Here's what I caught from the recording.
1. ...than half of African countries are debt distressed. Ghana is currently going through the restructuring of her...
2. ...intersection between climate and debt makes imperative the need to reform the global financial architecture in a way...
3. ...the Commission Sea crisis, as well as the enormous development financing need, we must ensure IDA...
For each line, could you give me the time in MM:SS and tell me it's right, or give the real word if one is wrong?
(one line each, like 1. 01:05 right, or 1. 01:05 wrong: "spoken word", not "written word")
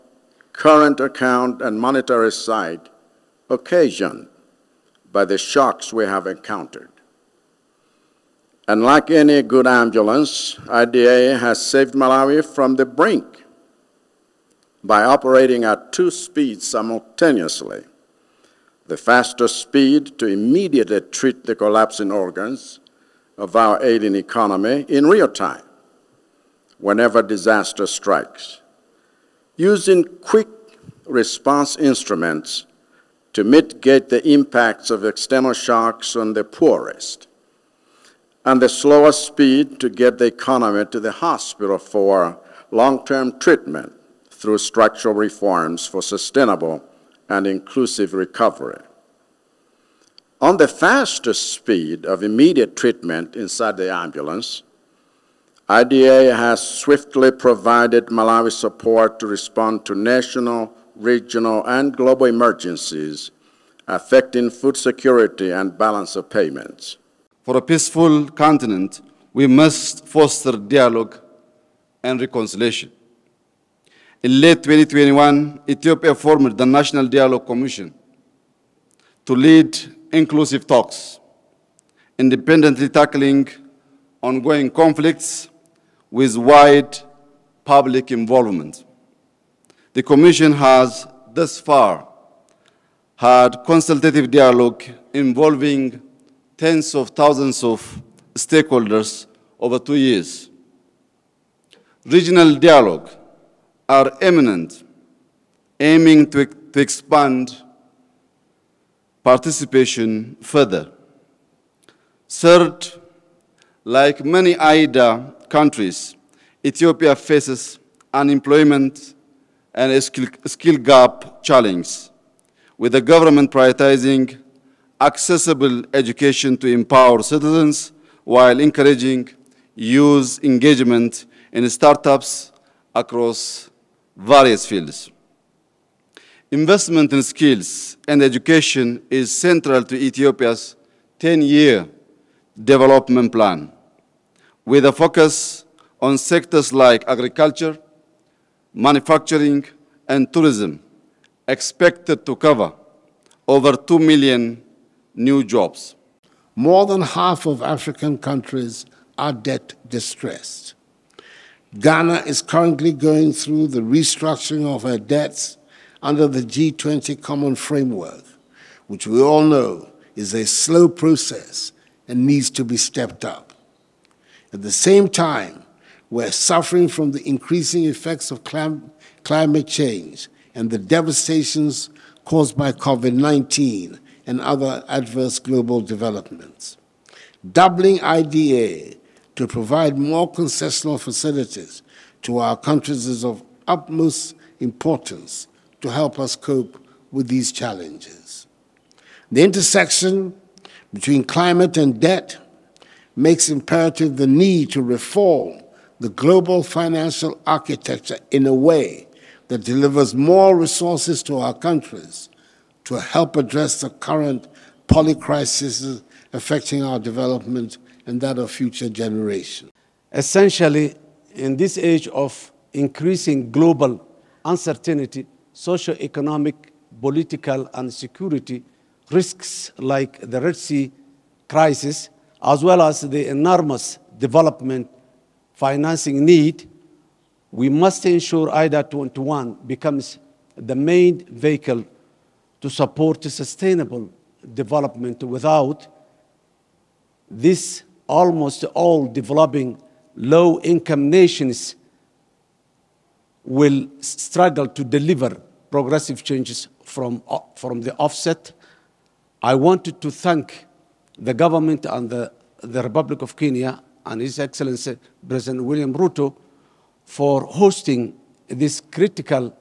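1. 02:36 right
2. 03:19 right
3. 03:50 wrong: "Red", not "Commission".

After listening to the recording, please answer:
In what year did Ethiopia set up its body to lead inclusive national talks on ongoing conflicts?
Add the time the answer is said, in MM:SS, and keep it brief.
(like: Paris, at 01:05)
2021, at 01:14.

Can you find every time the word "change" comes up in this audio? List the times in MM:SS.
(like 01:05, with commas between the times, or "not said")
02:59, 04:16.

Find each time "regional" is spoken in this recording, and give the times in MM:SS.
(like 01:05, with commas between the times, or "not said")
01:00, 01:42.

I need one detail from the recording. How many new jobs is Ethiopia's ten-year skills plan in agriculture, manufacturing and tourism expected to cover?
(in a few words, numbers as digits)
Over 2 million.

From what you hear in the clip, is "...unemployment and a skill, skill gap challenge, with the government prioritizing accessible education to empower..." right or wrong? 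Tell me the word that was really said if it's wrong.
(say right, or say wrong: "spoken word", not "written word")
right.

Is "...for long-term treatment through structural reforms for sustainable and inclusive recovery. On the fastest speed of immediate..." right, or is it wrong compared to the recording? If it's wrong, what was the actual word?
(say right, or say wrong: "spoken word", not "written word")
right.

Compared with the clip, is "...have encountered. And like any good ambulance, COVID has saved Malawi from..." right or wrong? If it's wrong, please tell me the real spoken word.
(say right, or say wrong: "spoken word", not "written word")
wrong: "IDA", not "COVID".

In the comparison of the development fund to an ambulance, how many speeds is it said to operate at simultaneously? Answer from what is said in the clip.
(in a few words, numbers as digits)
2.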